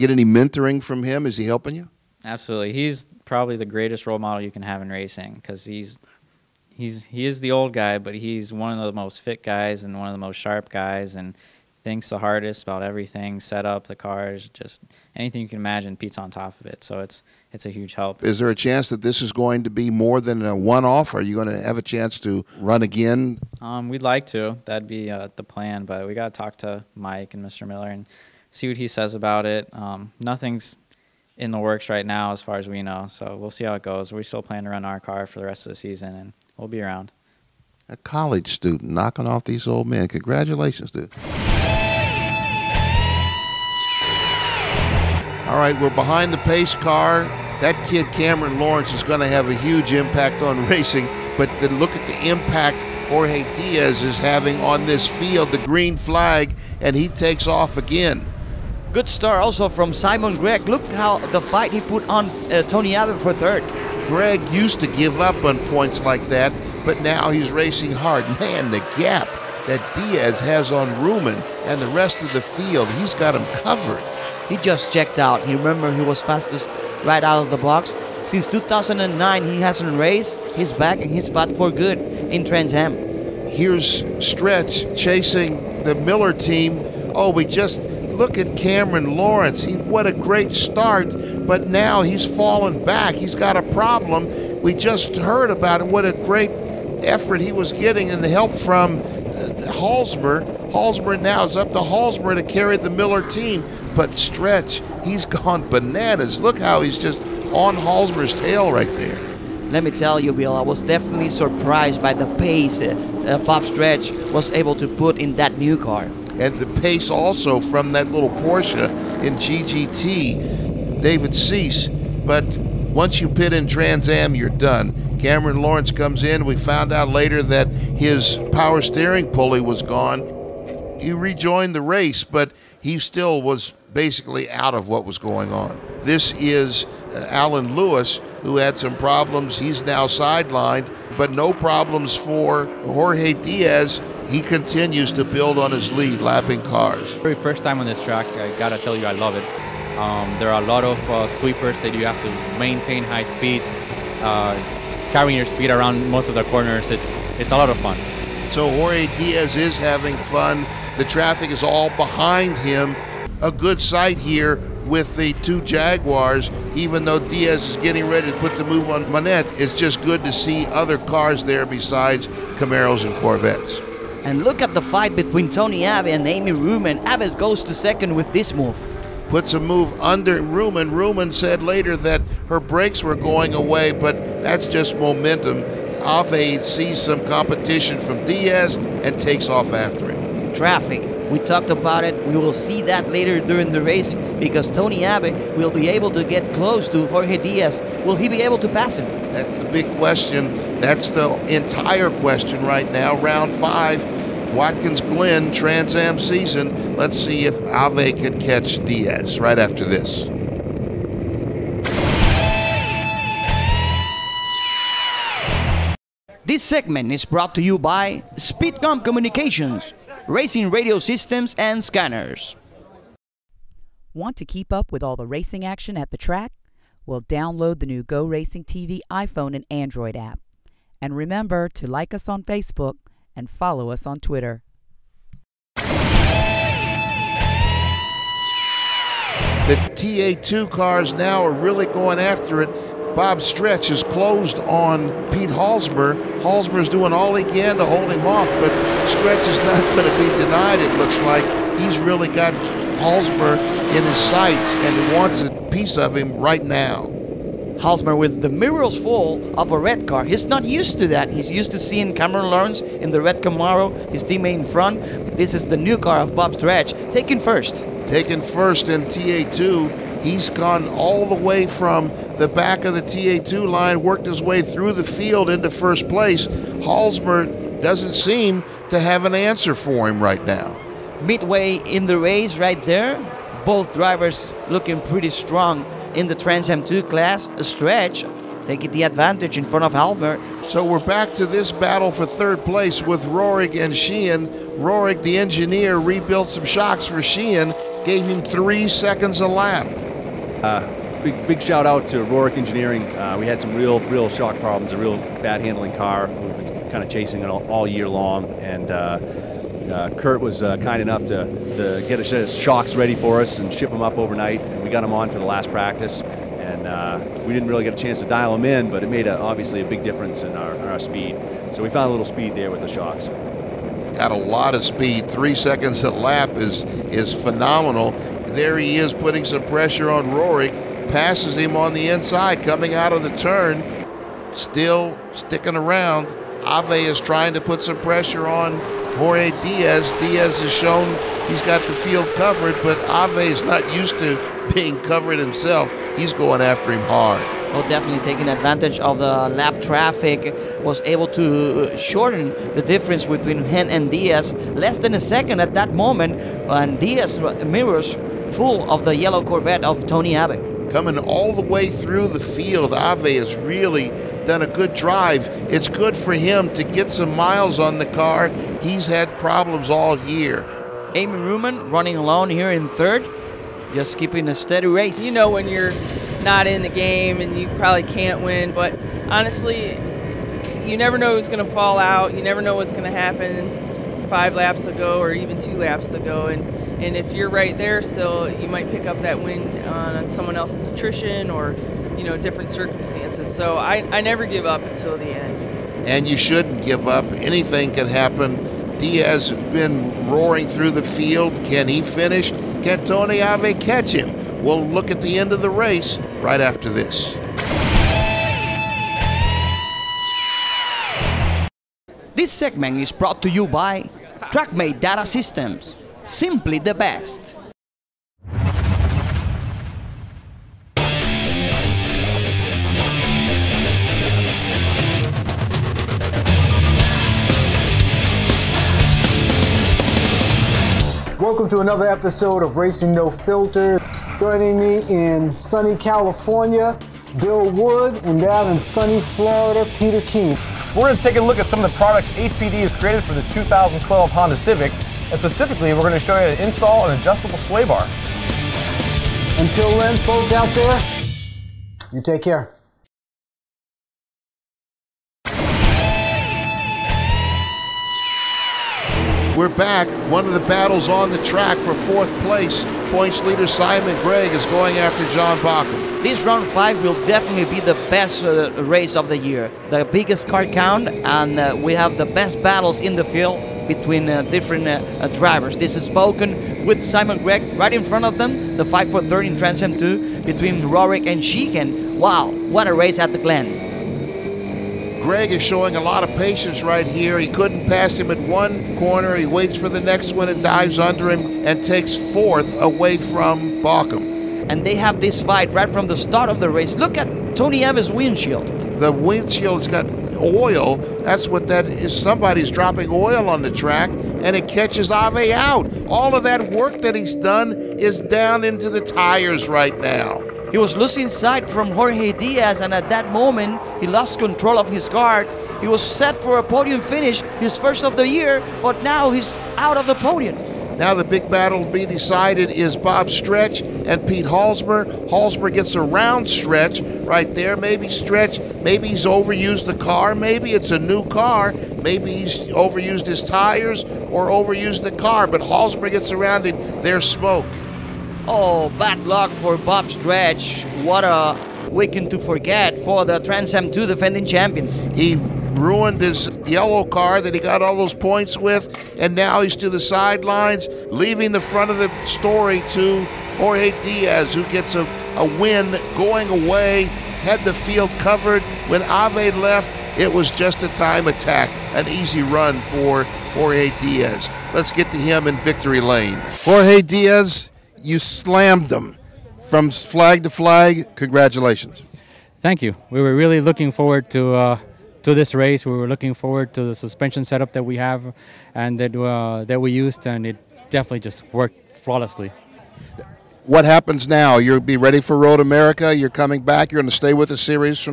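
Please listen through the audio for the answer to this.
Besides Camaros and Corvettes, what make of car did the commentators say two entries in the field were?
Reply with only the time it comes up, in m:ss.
2:45.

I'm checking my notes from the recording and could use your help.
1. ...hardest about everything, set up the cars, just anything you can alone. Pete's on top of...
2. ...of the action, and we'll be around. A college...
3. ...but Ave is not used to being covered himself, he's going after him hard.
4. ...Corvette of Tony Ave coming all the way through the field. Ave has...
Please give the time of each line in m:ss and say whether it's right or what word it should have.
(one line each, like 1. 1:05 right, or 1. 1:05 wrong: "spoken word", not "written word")
1. 0:12 wrong: "imagine", not "alone"
2. 0:35 wrong: "season", not "action"
3. 5:42 right
4. 5:59 right.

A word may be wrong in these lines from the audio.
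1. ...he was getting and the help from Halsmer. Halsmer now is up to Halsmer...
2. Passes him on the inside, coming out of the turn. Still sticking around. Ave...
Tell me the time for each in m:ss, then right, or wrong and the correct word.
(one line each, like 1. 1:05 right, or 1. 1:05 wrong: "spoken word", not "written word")
1. 1:37 right
2. 5:31 right.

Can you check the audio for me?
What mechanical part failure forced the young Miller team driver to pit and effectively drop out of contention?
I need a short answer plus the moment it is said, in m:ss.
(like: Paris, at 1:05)
Power steering pulley, at 2:08.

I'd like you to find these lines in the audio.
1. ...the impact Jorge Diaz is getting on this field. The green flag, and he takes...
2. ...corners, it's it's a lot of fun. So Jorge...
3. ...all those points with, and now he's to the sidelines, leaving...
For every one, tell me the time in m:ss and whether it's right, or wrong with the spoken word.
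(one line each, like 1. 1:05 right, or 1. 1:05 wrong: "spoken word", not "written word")
1. 0:52 wrong: "having", not "getting"
2. 2:36 right
3. 9:07 right.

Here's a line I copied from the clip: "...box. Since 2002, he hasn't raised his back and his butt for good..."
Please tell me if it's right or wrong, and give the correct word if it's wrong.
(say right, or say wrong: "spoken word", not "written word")
wrong: "2009", not "2002".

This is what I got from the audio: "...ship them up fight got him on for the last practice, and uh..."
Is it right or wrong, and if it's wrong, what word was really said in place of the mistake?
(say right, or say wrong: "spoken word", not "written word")
wrong: "overnight", not "fight".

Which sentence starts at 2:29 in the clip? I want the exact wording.
Um, there are a lot of uh, sweepers that you have to maintain high speeds.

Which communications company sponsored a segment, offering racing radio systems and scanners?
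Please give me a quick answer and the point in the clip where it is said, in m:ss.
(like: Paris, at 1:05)
Speedcom Communications, at 3:38.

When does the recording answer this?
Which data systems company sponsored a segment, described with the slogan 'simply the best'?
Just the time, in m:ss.
6:54.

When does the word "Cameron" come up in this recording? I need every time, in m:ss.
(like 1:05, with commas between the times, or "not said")
0:48, 1:28, 2:05, 4:22.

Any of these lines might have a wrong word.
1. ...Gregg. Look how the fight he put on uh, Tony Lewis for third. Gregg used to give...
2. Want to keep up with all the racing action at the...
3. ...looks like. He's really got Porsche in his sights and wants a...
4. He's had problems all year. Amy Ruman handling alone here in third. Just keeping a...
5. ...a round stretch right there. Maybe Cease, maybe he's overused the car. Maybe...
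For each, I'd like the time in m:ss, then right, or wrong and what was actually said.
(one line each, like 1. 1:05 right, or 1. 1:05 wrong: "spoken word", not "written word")
1. 1:00 wrong: "Ave", not "Lewis"
2. 3:44 right
3. 4:10 wrong: "Halsmer", not "Porsche"
4. 6:08 wrong: "running", not "handling"
5. 8:45 wrong: "Stretch", not "Cease".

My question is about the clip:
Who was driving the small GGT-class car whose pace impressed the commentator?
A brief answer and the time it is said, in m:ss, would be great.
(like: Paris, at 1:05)
David Cease, at 2:01.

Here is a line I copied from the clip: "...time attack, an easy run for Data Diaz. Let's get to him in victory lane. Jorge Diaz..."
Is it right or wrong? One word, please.
wrong.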